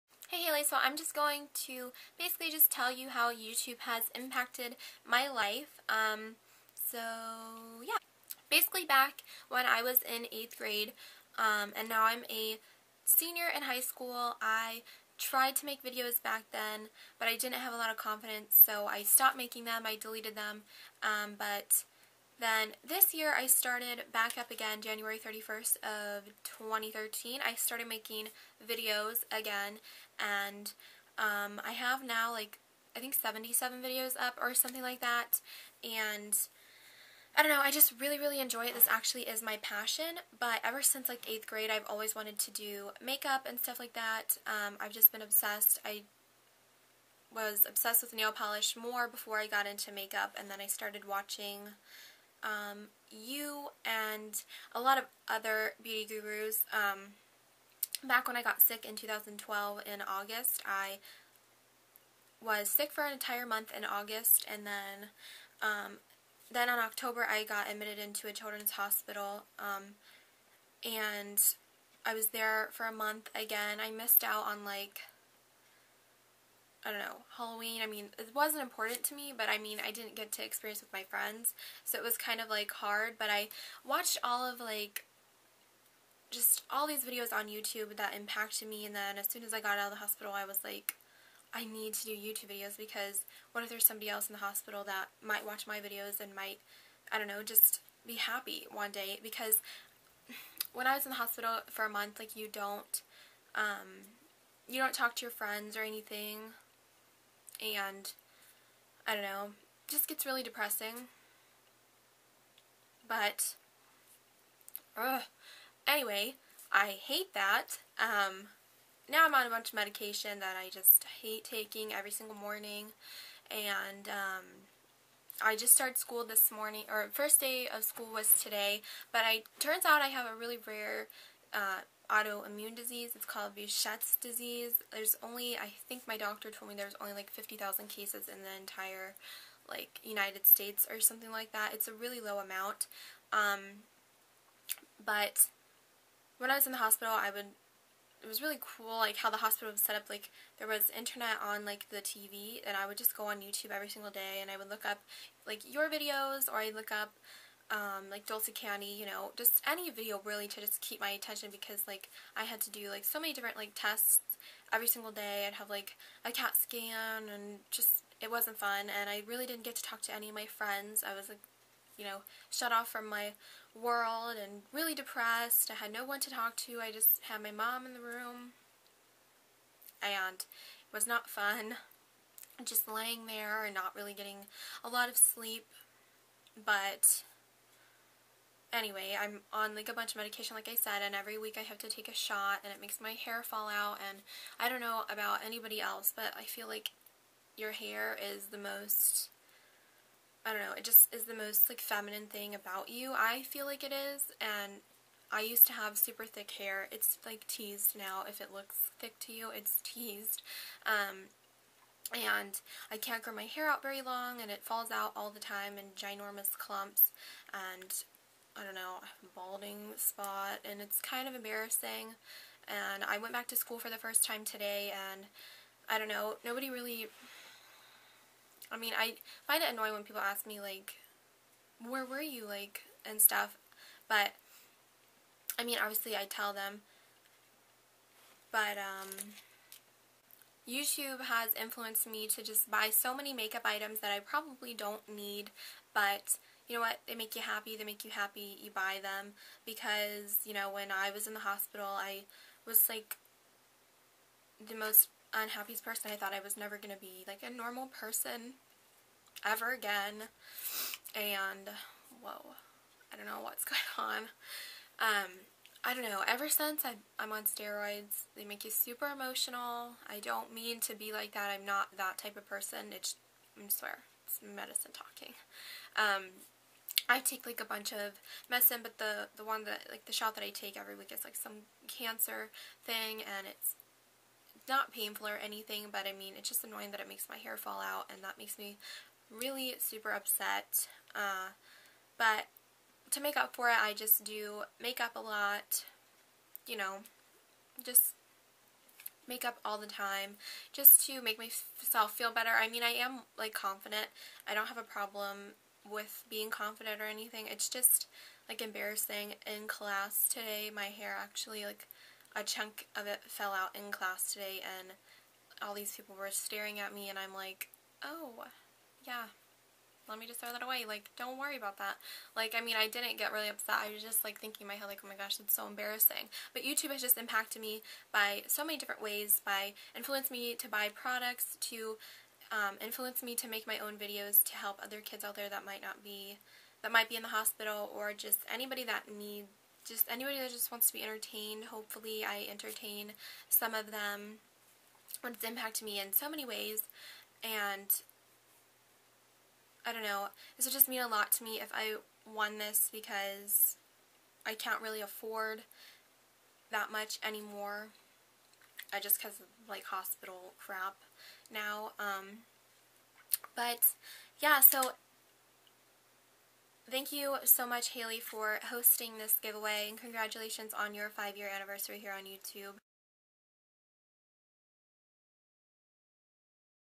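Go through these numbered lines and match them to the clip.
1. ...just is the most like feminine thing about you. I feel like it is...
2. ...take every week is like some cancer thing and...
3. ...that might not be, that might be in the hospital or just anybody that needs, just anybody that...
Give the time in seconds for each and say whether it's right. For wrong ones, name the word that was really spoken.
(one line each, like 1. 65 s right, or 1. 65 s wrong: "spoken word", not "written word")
1. 200 s right
2. 280 s right
3. 335 s right.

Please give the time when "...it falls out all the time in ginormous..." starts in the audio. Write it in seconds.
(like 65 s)
214 s.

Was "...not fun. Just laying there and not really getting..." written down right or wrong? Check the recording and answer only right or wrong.
right.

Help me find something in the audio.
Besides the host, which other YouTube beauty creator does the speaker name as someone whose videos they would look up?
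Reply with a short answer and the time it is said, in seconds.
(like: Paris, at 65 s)
Dulce Candy, at 158 s.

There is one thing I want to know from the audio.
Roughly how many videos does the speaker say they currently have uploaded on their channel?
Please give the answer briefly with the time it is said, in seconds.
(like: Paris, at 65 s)
77, at 33 s.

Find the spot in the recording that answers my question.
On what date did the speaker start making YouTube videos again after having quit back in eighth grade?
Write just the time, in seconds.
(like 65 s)
24 s.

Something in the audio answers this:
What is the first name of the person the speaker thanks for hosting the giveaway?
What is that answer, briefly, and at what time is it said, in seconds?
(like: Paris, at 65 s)
Hailey, at 367 s.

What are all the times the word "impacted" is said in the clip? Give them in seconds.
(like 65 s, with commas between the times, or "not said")
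4 s, 88 s, 327 s, 345 s.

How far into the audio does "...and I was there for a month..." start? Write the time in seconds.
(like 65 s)
70 s.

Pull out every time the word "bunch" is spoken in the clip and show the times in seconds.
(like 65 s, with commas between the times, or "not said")
119 s, 189 s, 277 s.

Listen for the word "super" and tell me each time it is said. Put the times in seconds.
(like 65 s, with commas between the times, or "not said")
205 s, 268 s, 289 s.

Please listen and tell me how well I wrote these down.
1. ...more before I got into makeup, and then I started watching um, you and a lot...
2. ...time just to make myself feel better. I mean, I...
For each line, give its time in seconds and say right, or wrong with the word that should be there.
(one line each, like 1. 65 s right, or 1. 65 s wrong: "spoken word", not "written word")
1. 48 s right
2. 299 s right.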